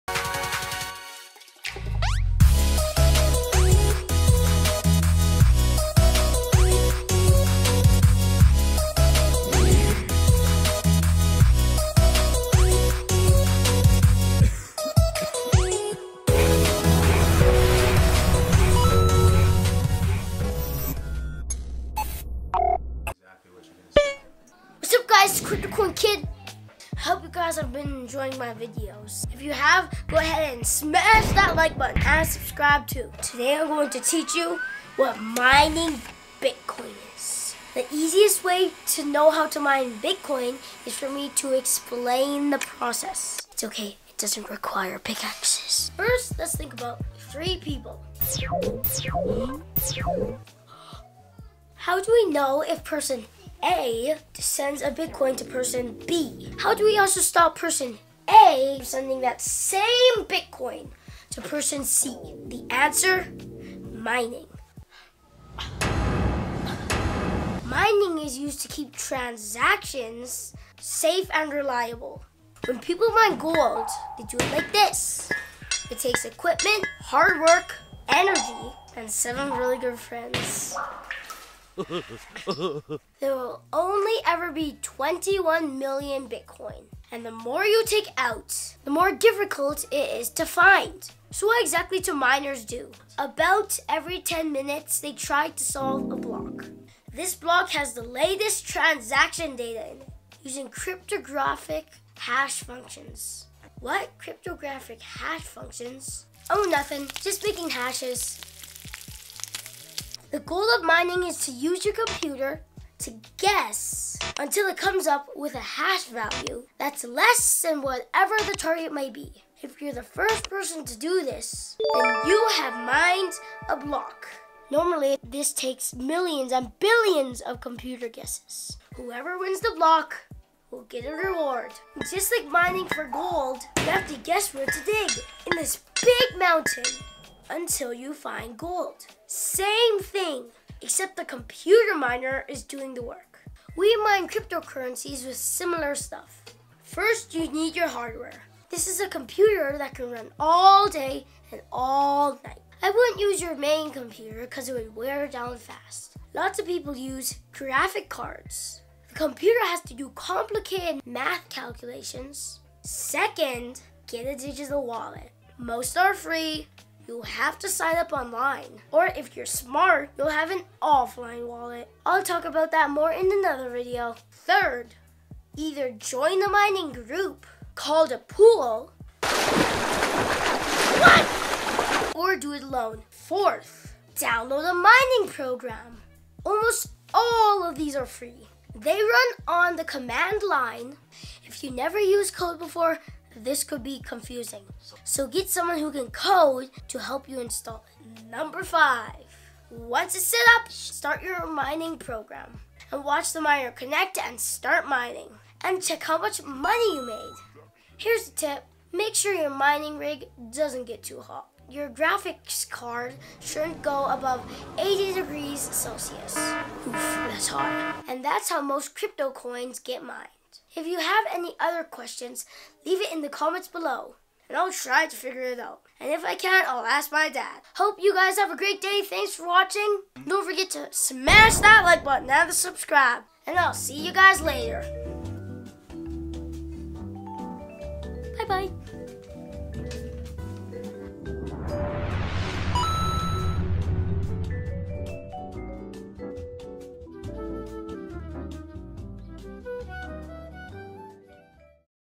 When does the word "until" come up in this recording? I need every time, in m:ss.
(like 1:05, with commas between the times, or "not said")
1:54, 2:17.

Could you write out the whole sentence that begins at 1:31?
So, what exactly do miners do?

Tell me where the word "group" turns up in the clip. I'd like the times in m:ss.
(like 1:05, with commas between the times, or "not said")
2:56.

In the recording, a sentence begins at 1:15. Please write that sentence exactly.
It takes equipment, hard work, energy, and seven really good friends.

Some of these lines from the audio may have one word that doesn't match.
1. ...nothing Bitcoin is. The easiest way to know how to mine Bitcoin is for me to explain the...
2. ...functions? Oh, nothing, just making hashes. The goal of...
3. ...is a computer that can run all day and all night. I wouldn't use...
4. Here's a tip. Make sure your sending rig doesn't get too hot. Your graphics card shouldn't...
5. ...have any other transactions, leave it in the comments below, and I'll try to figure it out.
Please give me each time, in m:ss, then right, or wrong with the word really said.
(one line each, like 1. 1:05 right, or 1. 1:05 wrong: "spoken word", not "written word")
1. 0:35 wrong: "mining", not "nothing"
2. 1:45 right
3. 2:28 right
4. 3:27 wrong: "mining", not "sending"
5. 3:40 wrong: "questions", not "transactions".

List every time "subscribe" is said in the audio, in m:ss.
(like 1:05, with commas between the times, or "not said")
0:32, 3:52.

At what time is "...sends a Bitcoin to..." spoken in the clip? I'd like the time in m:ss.
0:54.